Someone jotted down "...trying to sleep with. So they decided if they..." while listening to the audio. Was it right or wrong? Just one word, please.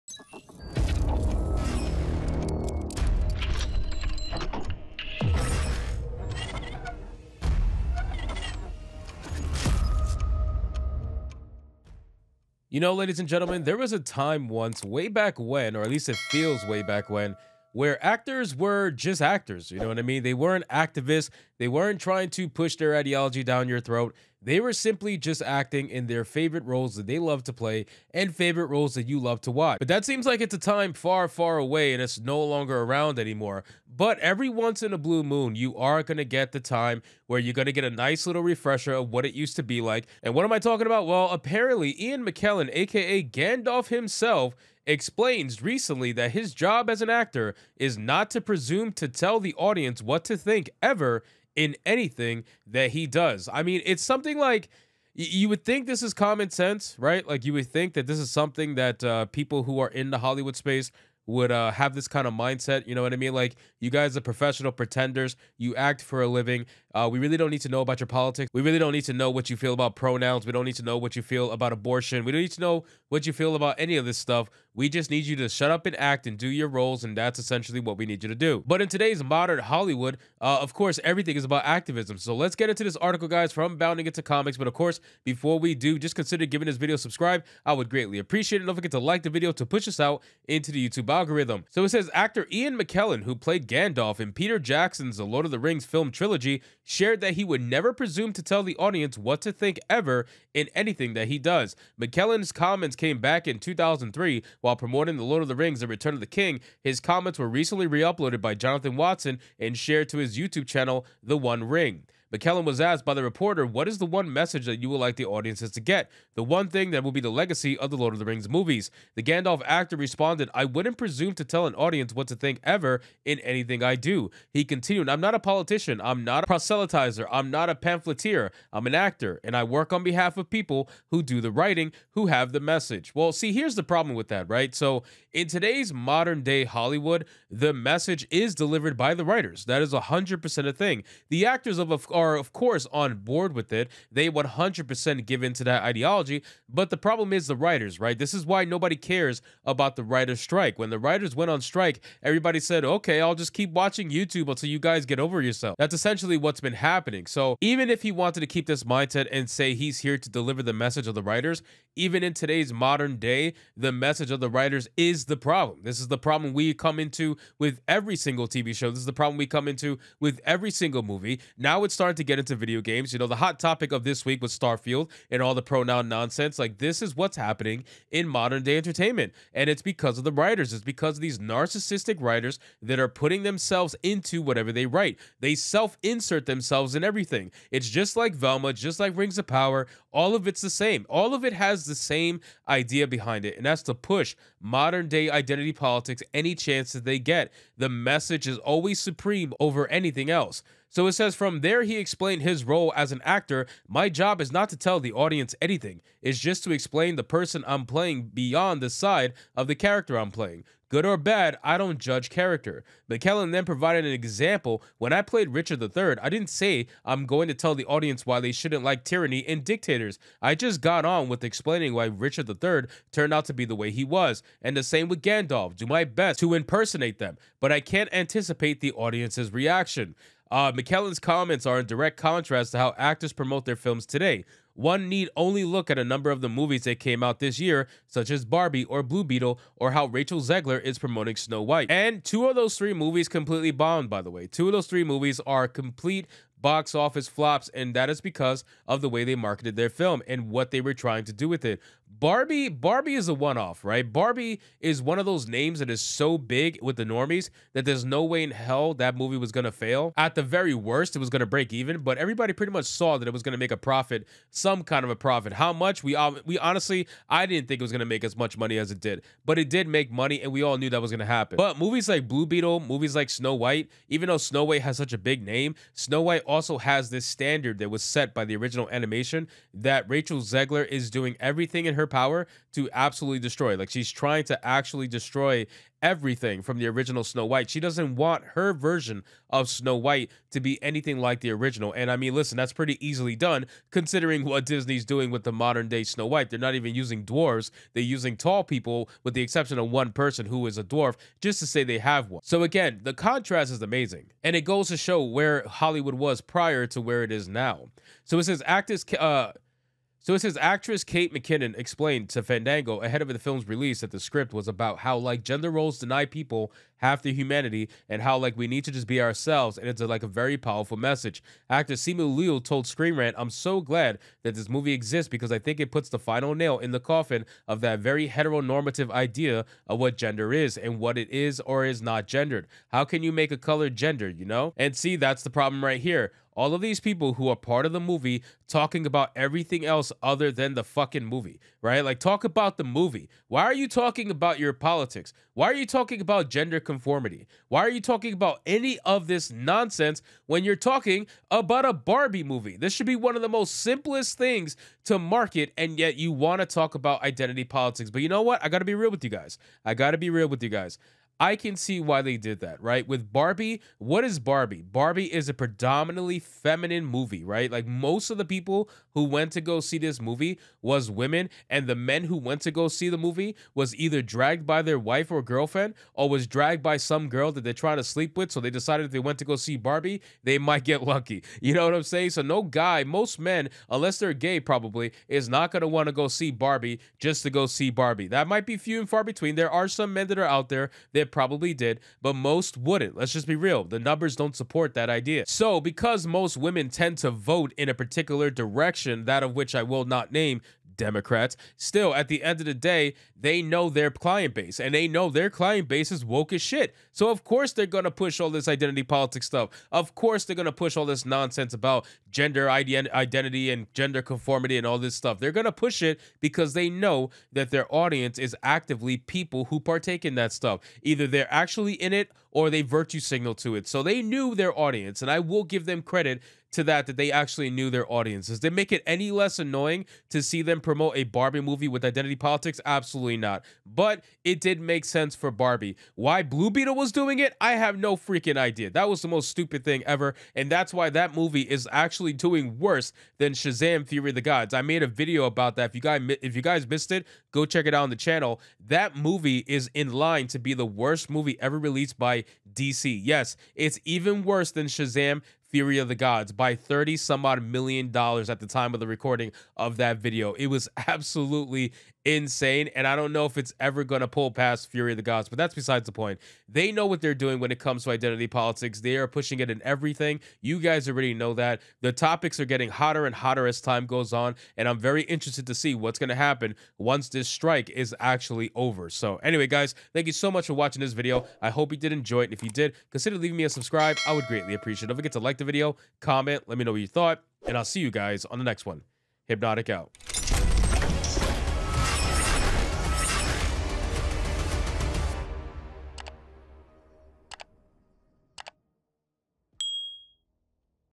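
right.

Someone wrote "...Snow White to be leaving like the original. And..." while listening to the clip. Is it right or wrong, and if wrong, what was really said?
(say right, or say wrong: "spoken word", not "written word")
wrong: "anything", not "leaving".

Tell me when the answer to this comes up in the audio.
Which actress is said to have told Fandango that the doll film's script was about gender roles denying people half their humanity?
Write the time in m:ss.
5:11.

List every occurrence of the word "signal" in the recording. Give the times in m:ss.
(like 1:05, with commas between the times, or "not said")
7:03.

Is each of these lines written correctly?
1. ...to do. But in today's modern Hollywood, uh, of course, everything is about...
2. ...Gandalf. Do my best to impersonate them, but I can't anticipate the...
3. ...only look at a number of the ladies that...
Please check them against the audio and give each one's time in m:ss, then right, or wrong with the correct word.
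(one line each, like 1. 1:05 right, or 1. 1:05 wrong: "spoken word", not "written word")
1. 1:18 right
2. 3:45 right
3. 3:55 wrong: "movies", not "ladies".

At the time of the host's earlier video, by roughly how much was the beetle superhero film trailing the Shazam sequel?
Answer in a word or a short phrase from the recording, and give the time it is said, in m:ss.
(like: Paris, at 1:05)
30 some odd million dollars, at 7:36.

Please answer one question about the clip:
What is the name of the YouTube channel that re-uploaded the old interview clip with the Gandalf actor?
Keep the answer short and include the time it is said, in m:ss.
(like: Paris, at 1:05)
The One Ring, at 1:51.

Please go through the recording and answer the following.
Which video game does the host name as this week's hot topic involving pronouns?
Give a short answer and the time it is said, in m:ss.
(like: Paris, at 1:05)
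Starfield, at 2:54.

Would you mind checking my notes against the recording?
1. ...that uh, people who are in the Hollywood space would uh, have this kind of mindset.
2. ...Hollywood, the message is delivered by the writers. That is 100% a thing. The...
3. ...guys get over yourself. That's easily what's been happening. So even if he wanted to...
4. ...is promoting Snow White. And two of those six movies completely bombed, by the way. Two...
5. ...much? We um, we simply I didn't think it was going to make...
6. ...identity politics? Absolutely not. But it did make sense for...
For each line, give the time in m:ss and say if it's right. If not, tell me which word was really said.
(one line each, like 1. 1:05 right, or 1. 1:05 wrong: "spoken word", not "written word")
1. 0:58 right
2. 2:16 right
3. 2:34 wrong: "essentially", not "easily"
4. 4:00 wrong: "three", not "six"
5. 4:25 wrong: "honestly", not "simply"
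6. 7:12 right.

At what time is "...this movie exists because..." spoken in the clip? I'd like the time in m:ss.
5:24.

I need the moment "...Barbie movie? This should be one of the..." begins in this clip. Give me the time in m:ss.
5:51.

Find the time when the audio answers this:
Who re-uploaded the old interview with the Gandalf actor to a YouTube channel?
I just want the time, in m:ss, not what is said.
1:48.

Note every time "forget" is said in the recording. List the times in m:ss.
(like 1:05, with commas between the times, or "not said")
1:28, 8:05.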